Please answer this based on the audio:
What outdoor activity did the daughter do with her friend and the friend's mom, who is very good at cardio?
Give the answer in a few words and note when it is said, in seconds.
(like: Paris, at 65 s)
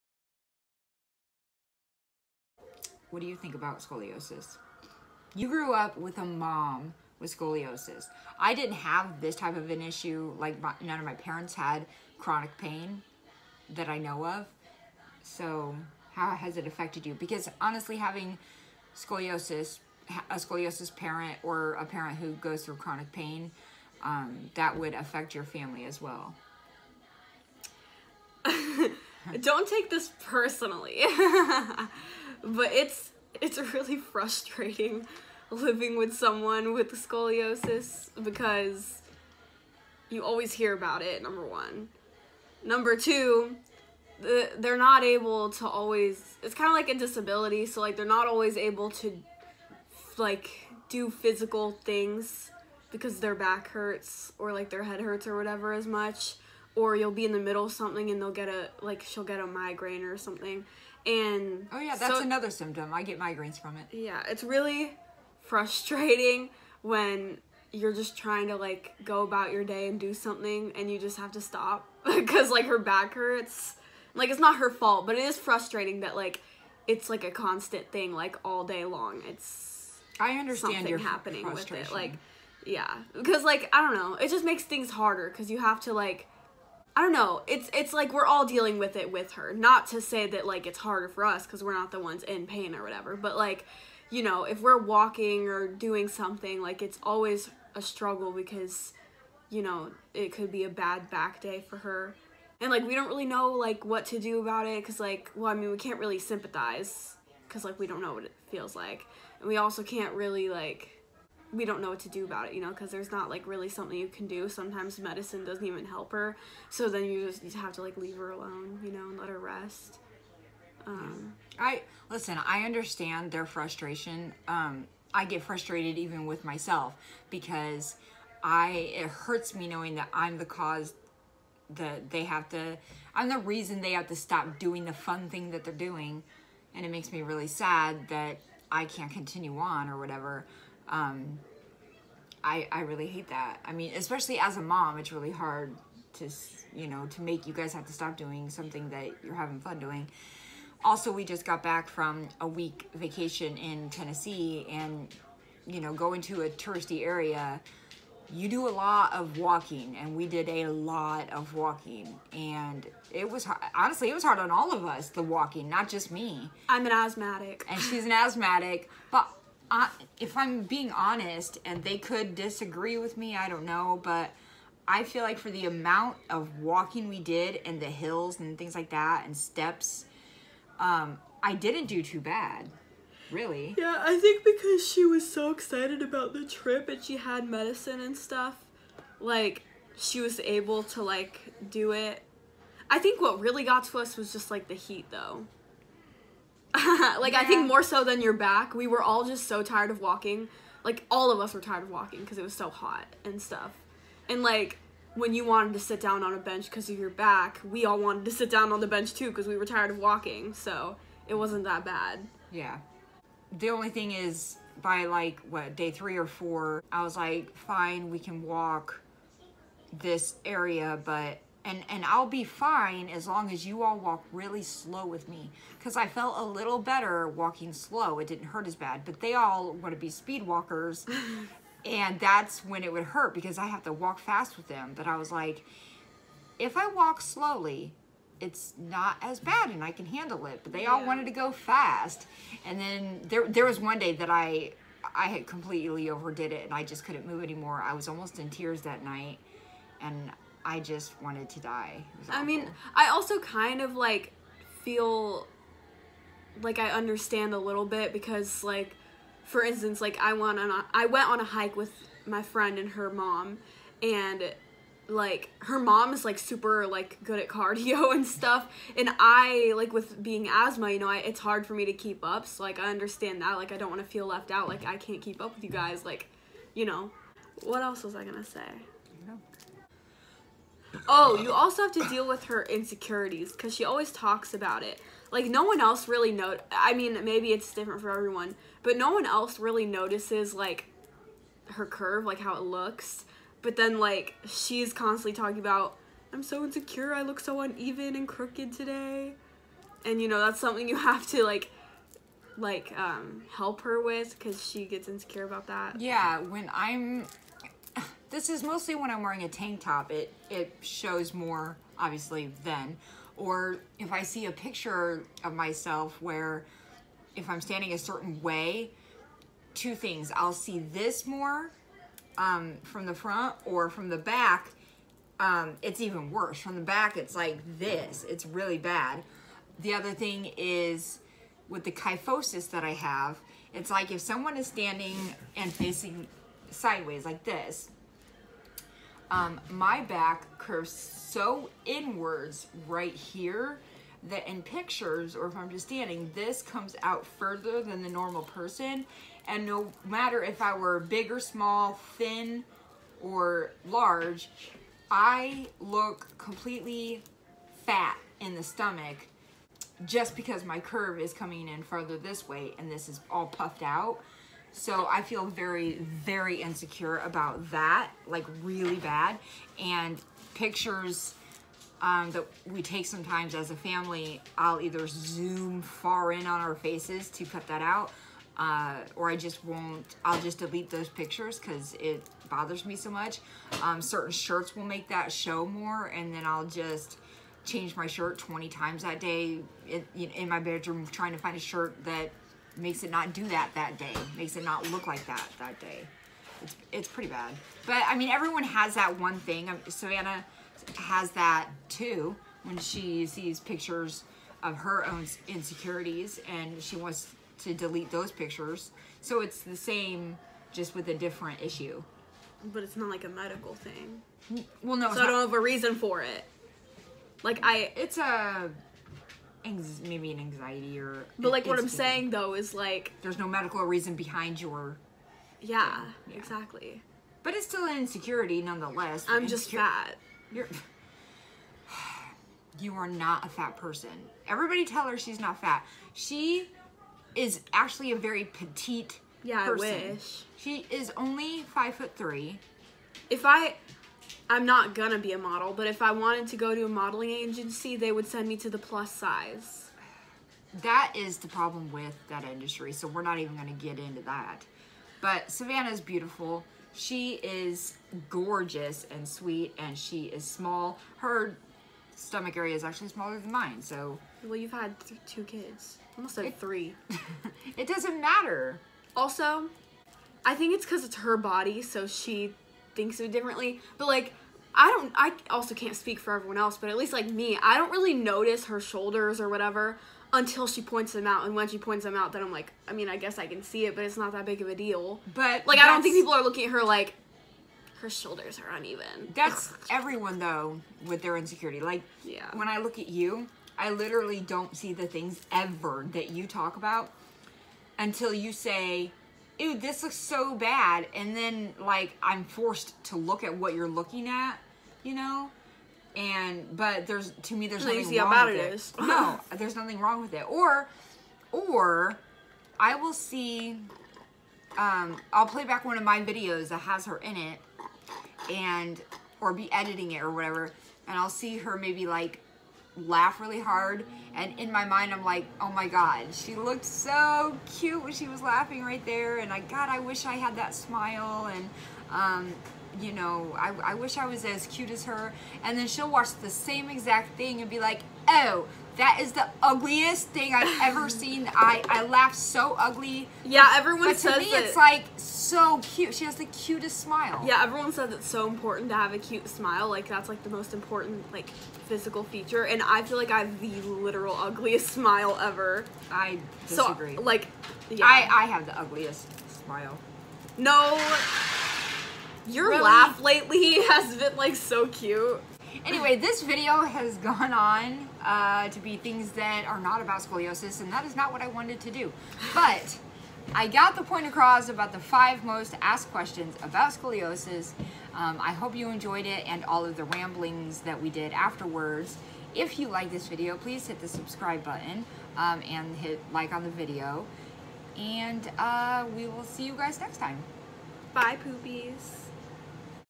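a hike, at 261 s.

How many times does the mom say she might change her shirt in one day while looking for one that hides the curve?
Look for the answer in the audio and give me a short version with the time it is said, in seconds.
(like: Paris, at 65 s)
20, at 388 s.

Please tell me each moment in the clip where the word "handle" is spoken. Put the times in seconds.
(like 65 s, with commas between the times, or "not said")
240 s.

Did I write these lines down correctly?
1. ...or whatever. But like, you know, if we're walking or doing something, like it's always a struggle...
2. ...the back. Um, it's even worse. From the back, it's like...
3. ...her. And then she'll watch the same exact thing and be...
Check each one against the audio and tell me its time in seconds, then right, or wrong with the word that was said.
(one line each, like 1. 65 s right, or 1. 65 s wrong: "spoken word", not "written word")
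1. 92 s right
2. 324 s right
3. 535 s right.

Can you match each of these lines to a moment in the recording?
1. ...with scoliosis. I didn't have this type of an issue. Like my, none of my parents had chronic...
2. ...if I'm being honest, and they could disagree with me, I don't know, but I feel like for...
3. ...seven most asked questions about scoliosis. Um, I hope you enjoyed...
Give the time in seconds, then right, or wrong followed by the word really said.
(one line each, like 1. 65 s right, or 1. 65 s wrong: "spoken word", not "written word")
1. 7 s right
2. 170 s right
3. 574 s wrong: "five", not "seven".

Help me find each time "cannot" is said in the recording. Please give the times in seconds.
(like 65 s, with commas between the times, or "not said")
not said.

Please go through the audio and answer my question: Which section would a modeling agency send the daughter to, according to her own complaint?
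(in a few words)
plus size.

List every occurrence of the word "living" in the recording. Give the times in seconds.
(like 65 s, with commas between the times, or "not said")
35 s.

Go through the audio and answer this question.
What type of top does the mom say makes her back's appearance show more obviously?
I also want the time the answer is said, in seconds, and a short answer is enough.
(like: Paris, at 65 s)
tank top, at 309 s.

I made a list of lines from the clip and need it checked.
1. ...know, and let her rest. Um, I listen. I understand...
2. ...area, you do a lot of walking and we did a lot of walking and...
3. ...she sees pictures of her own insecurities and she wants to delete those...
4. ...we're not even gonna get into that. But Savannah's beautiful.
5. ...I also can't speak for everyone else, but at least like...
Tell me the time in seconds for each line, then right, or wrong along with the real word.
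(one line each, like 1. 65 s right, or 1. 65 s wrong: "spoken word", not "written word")
1. 118 s right
2. 157 s right
3. 402 s right
4. 453 s right
5. 475 s right.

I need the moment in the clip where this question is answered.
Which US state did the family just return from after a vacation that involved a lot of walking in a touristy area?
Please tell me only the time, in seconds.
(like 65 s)
153 s.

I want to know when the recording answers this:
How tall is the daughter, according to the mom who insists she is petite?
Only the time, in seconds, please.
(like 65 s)
441 s.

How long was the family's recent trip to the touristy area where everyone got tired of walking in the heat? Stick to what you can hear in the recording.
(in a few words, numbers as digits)
a week.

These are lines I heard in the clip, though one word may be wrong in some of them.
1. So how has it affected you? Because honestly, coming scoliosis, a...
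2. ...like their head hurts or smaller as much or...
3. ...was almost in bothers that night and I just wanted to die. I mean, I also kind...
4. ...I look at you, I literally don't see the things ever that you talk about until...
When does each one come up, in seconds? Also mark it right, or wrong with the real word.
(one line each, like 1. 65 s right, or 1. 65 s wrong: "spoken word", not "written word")
1. 15 s wrong: "having", not "coming"
2. 54 s wrong: "whatever", not "smaller"
3. 247 s wrong: "tears", not "bothers"
4. 492 s right.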